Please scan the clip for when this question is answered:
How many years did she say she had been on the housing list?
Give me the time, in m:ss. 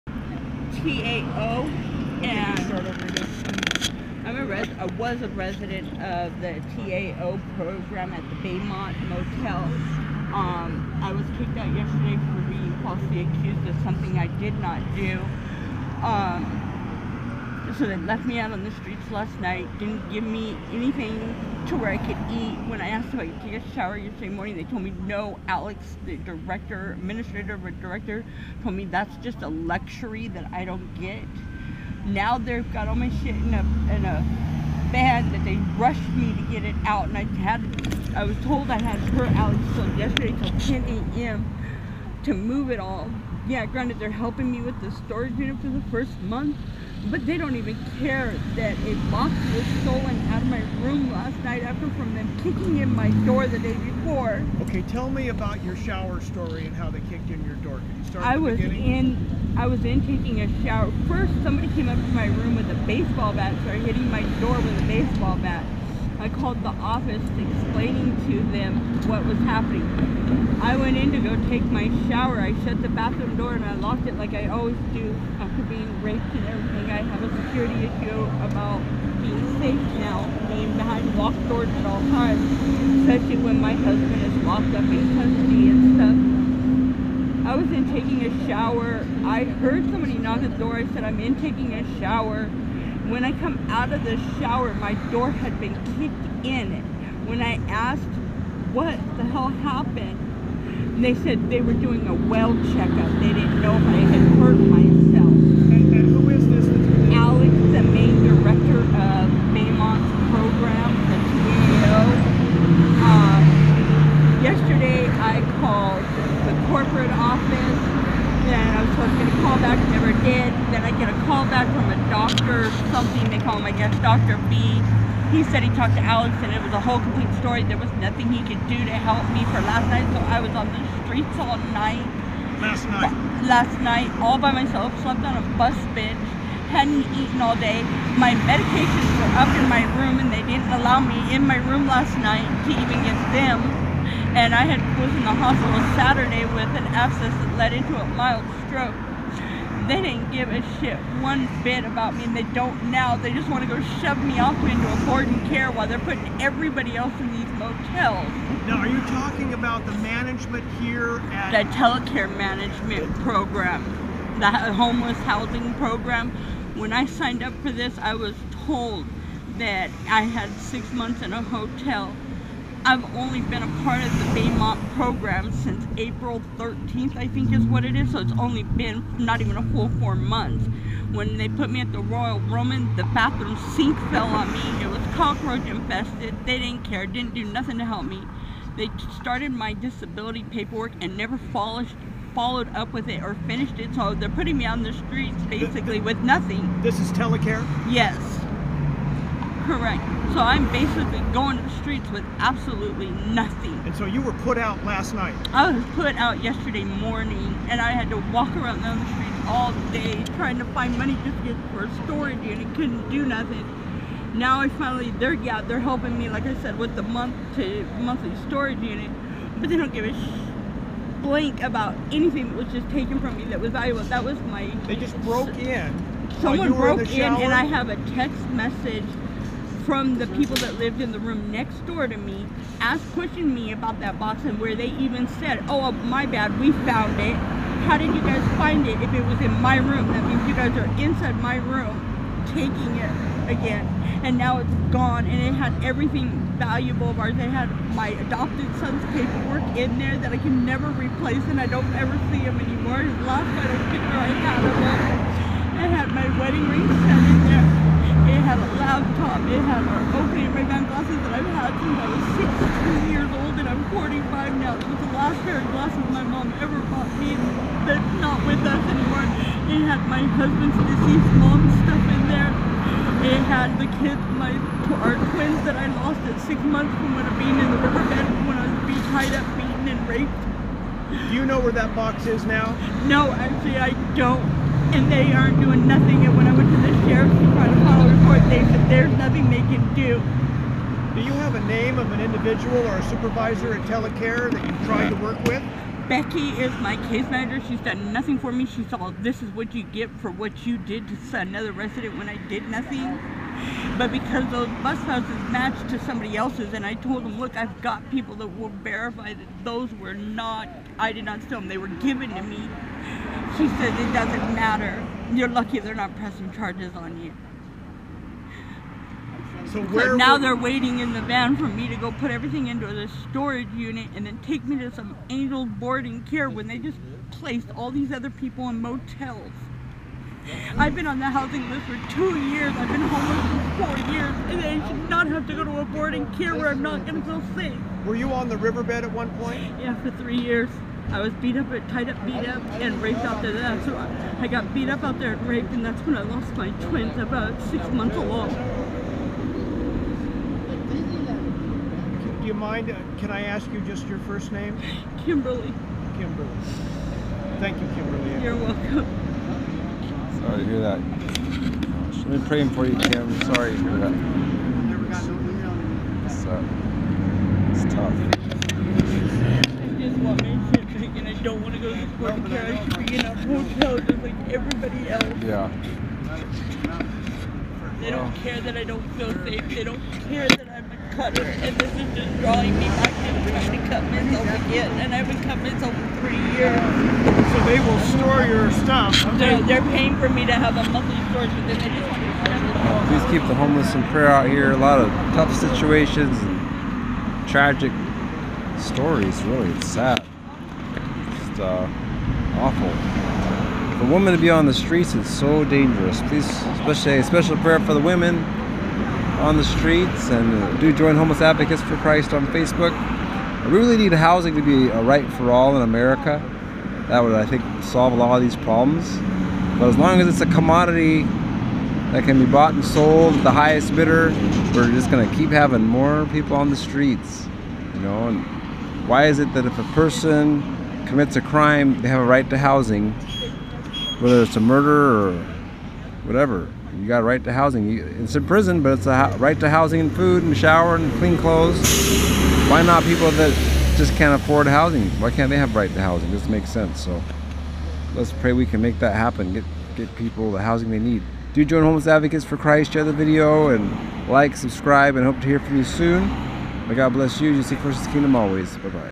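5:32.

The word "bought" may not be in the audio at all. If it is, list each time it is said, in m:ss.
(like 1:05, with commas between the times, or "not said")
4:26, 7:02.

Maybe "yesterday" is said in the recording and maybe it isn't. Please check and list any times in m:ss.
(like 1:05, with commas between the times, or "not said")
0:11, 0:23, 0:39, 1:54, 3:26.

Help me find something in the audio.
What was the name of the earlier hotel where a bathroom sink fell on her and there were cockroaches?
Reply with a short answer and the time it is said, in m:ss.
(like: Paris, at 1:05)
Royal Roman, at 3:01.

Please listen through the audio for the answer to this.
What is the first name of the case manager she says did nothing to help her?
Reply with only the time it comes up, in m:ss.
4:56.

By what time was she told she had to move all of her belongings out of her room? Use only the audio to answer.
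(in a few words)
10 a.m.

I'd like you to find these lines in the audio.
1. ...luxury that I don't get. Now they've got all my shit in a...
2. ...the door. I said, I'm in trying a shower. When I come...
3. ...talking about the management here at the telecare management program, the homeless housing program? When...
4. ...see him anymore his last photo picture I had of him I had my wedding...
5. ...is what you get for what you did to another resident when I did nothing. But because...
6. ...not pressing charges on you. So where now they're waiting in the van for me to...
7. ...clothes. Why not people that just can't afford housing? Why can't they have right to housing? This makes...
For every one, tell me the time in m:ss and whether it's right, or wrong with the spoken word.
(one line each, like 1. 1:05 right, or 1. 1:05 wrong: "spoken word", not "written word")
1. 0:29 right
2. 1:30 wrong: "taking", not "trying"
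3. 2:39 right
4. 4:12 right
5. 4:59 right
6. 5:15 right
7. 7:21 right.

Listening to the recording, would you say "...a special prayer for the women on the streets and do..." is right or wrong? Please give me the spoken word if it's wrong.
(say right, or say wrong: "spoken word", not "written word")
right.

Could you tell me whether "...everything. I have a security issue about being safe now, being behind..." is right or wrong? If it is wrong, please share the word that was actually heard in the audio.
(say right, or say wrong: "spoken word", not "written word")
right.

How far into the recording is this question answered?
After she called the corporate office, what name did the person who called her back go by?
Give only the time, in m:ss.
2:04.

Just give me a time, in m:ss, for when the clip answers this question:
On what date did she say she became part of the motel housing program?
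2:55.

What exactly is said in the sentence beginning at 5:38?
Were you on the riverbed at one point?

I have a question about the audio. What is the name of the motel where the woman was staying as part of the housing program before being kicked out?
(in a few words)
Baymont Motel.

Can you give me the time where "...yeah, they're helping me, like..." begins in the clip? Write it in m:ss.
3:35.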